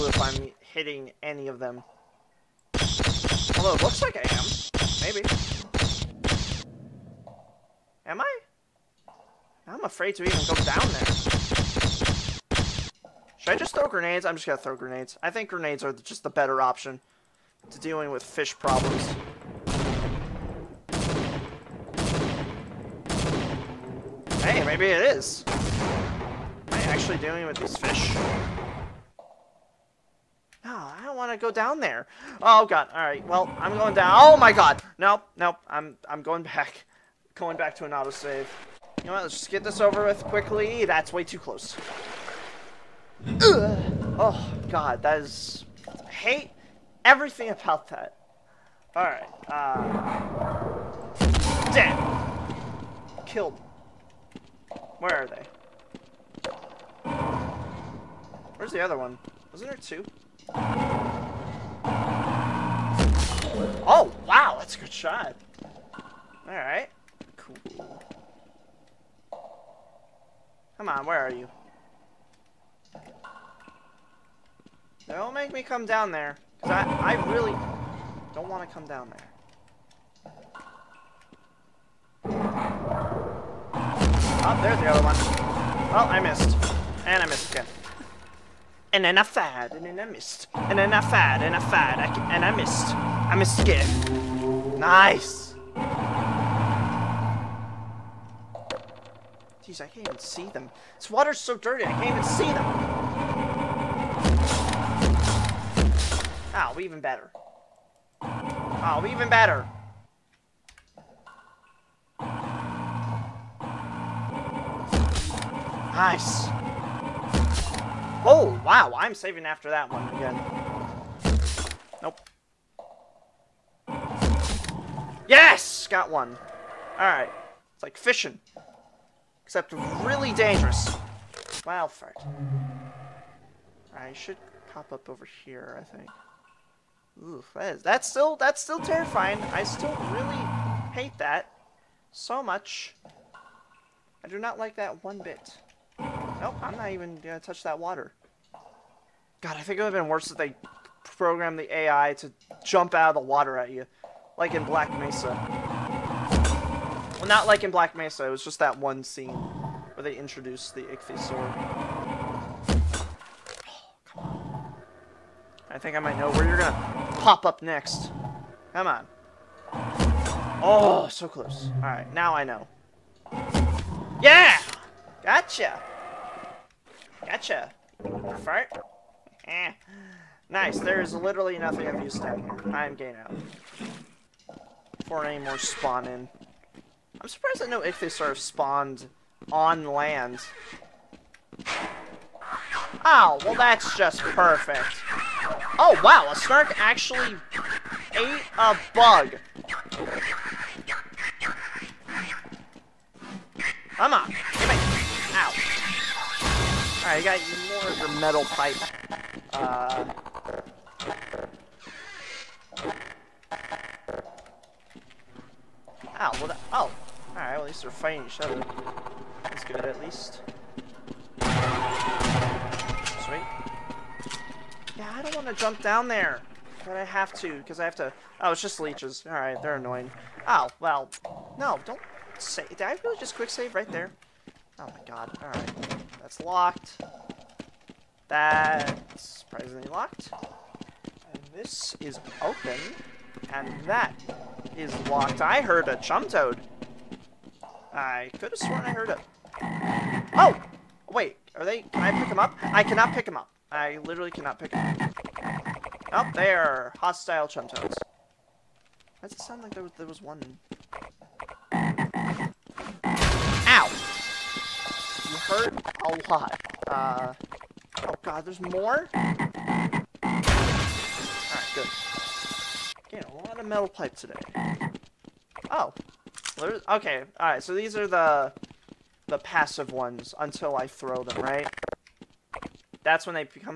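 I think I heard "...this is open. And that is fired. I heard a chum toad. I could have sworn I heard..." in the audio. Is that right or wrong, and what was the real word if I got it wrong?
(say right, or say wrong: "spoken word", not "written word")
wrong: "locked", not "fired".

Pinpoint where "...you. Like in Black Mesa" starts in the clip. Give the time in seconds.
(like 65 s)
153 s.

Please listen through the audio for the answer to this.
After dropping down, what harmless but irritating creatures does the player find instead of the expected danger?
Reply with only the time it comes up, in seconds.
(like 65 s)
228 s.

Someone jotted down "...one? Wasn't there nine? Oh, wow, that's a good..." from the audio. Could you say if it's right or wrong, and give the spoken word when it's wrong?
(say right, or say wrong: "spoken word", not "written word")
wrong: "two", not "nine".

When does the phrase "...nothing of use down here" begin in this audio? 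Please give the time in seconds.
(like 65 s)
181 s.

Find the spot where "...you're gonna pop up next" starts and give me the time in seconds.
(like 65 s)
166 s.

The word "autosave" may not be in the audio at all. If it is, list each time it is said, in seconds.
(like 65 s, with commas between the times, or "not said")
37 s.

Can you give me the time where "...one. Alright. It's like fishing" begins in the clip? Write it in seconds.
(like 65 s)
126 s.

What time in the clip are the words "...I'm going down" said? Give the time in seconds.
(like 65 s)
33 s.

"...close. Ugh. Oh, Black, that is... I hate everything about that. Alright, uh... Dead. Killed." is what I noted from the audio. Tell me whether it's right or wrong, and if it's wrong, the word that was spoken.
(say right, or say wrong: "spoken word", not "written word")
wrong: "God", not "Black".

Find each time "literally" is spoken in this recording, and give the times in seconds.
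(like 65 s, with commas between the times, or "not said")
181 s, 254 s.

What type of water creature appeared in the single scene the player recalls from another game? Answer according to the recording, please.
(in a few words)
Ichthyosaur.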